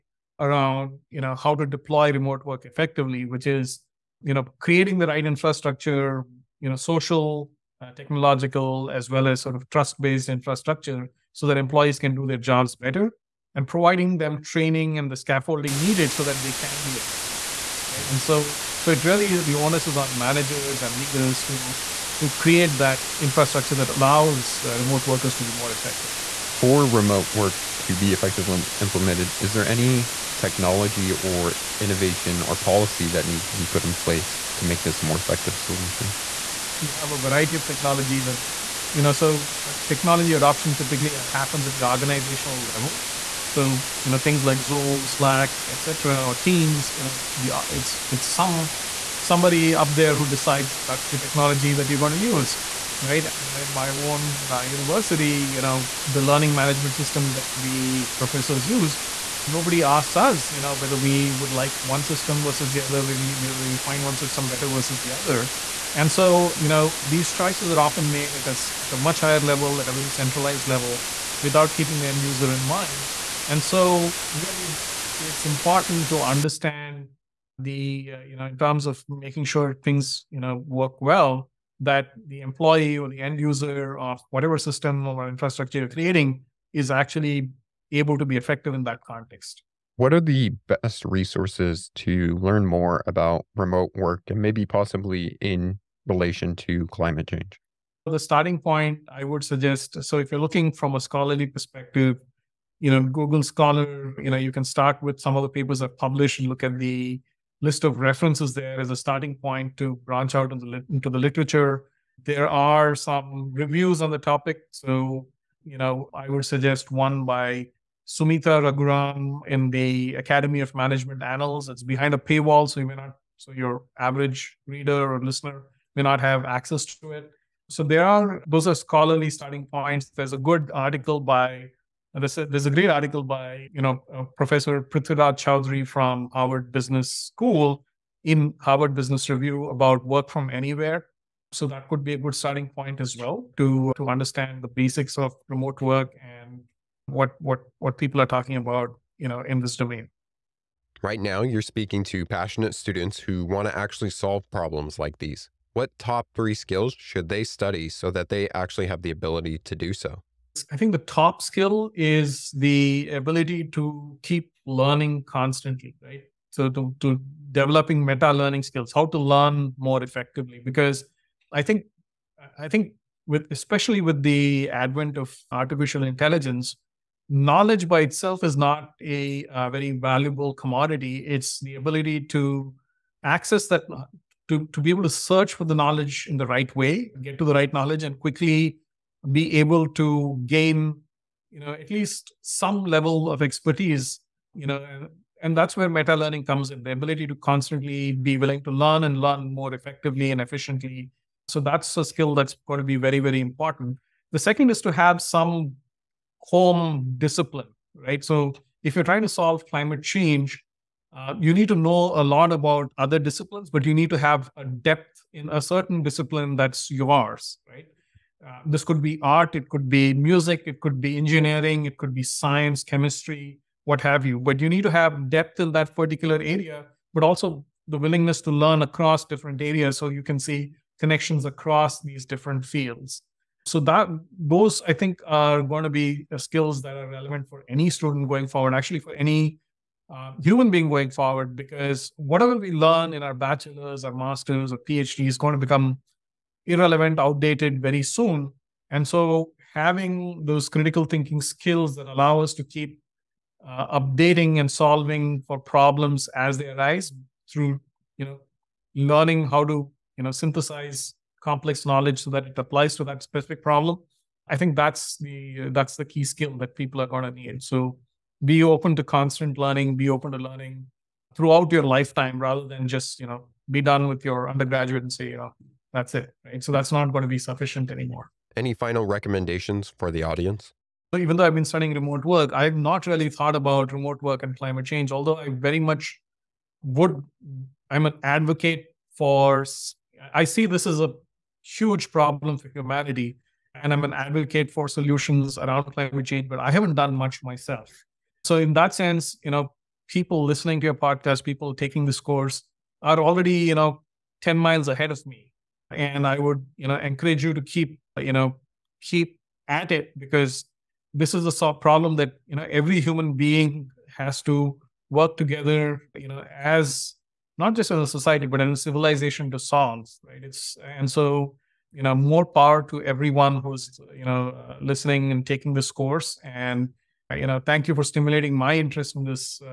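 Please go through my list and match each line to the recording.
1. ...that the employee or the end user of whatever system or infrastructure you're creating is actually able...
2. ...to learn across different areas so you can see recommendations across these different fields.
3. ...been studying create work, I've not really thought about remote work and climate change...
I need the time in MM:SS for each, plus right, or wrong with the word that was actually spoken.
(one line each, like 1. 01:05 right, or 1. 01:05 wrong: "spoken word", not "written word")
1. 01:21 right
2. 03:48 wrong: "connections", not "recommendations"
3. 04:41 wrong: "remote", not "create".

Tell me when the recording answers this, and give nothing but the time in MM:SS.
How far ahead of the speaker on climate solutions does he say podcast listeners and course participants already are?
05:04.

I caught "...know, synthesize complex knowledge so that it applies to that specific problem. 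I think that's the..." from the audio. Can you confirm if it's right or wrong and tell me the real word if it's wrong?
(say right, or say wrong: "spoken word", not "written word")
right.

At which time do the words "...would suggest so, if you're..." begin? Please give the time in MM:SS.
01:39.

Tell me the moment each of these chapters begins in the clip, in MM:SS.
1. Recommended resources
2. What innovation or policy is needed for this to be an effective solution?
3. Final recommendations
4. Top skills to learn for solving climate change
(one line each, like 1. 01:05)
1. 01:29
2. 00:25
3. 04:37
4. 02:29.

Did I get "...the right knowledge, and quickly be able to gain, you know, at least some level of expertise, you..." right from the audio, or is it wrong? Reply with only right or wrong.
right.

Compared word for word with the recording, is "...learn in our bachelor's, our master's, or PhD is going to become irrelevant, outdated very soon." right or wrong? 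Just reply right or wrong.
right.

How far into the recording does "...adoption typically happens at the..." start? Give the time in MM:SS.
00:40.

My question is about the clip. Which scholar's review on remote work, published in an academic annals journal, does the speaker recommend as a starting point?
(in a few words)
Sumita Raghuram.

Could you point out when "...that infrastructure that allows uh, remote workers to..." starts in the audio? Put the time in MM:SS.
00:22.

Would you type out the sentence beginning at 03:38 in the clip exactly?
Uh, this could be art, it could be music, it could be engineering, it could be science, chemistry, what have you.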